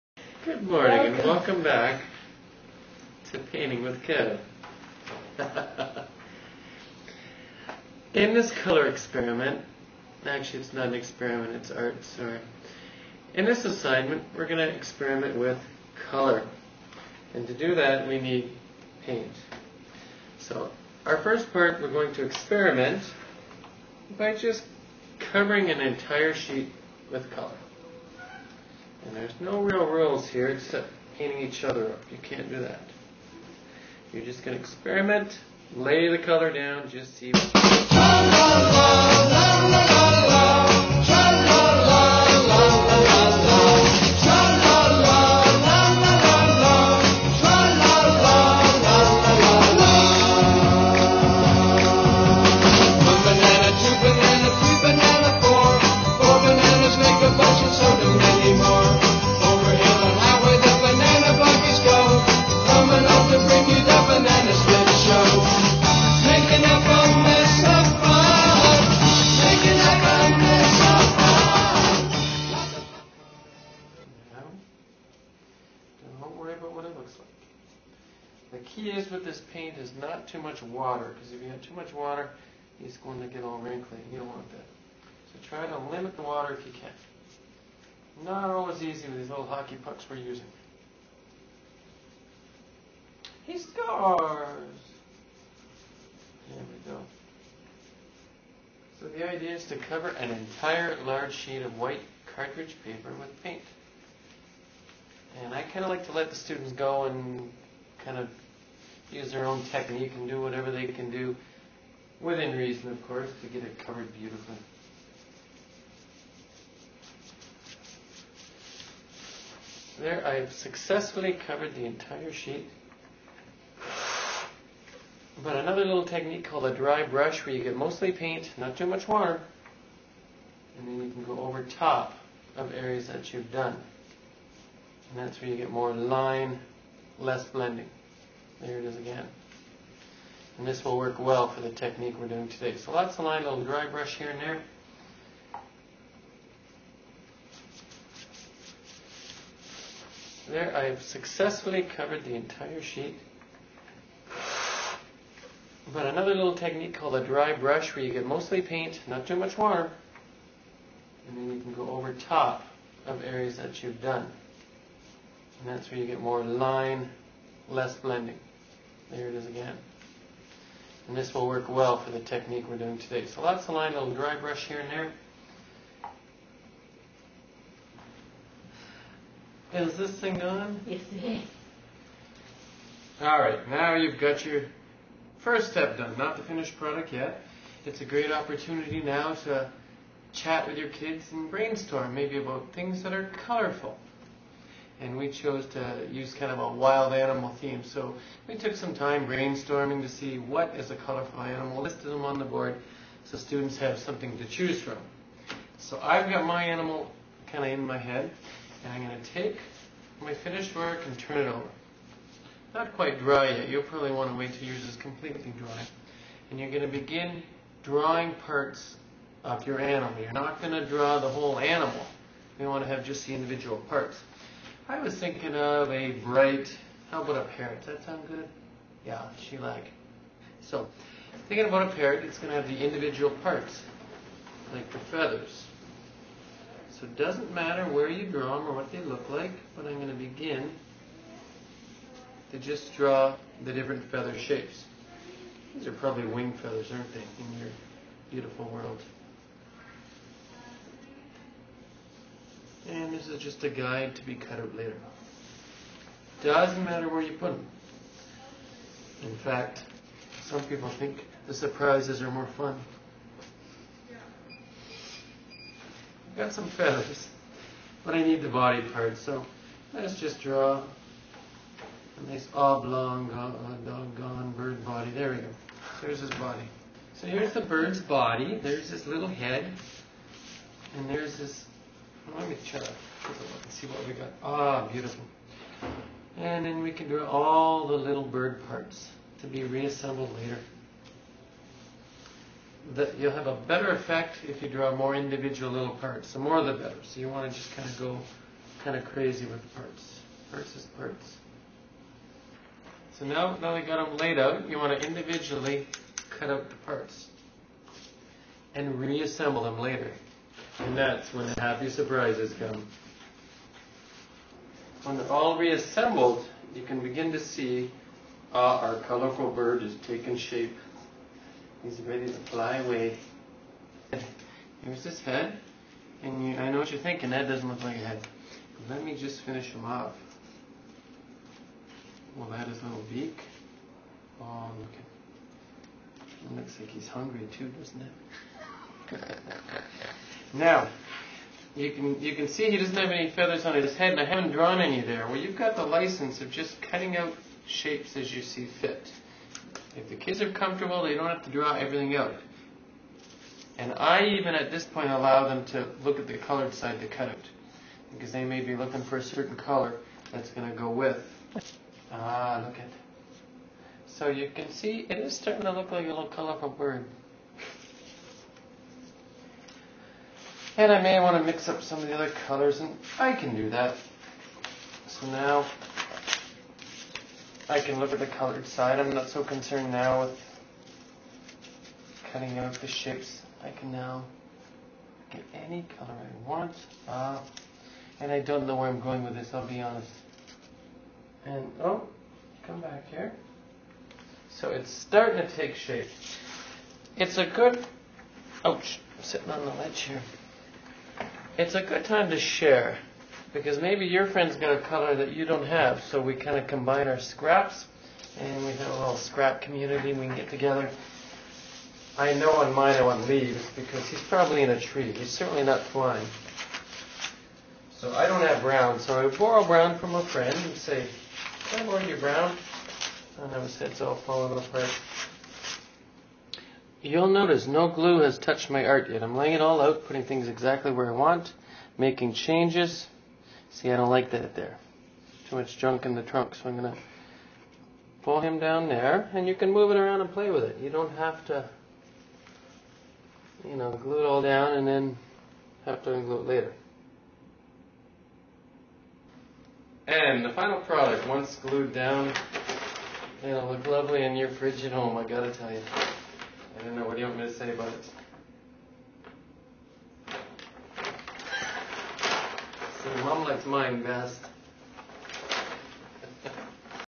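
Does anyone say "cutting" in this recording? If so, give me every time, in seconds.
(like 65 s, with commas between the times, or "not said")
346 s, 382 s.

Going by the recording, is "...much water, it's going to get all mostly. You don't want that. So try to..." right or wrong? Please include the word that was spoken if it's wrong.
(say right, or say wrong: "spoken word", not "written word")
wrong: "wrinkly", not "mostly".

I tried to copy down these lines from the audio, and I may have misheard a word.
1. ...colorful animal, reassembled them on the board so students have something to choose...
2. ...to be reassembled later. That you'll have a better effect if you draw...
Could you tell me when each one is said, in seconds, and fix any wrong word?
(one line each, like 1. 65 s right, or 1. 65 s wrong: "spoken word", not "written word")
1. 200 s wrong: "listed", not "reassembled"
2. 289 s right.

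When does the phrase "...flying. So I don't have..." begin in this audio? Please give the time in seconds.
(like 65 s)
415 s.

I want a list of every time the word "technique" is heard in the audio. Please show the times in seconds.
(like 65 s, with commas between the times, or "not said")
109 s, 126 s, 141 s, 156 s, 172 s.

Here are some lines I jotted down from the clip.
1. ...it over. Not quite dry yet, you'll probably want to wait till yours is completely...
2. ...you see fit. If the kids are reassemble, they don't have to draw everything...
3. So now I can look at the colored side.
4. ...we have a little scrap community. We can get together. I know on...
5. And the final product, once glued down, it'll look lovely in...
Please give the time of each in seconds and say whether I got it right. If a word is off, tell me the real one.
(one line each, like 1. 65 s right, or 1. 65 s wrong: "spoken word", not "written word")
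1. 211 s right
2. 348 s wrong: "comfortable", not "reassemble"
3. 375 s right
4. 408 s right
5. 450 s right.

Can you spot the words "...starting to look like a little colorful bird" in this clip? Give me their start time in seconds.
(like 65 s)
365 s.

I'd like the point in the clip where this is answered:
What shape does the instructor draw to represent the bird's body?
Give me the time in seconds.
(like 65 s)
272 s.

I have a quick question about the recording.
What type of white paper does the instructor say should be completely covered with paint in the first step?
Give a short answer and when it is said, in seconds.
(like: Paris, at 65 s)
cartridge paper, at 101 s.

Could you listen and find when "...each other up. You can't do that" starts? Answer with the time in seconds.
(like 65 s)
31 s.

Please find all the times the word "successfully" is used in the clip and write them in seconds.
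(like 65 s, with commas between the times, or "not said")
120 s, 151 s.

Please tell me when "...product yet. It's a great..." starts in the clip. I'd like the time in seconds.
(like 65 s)
186 s.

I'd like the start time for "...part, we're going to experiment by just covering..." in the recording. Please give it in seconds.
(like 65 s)
21 s.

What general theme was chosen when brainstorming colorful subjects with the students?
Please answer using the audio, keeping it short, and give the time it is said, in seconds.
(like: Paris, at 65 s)
wild animal, at 196 s.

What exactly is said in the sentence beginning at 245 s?
These are probably wing feathers, aren't they, in your beautiful world?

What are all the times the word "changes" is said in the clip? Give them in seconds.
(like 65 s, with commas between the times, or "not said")
432 s.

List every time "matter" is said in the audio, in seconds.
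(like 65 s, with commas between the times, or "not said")
237 s, 256 s.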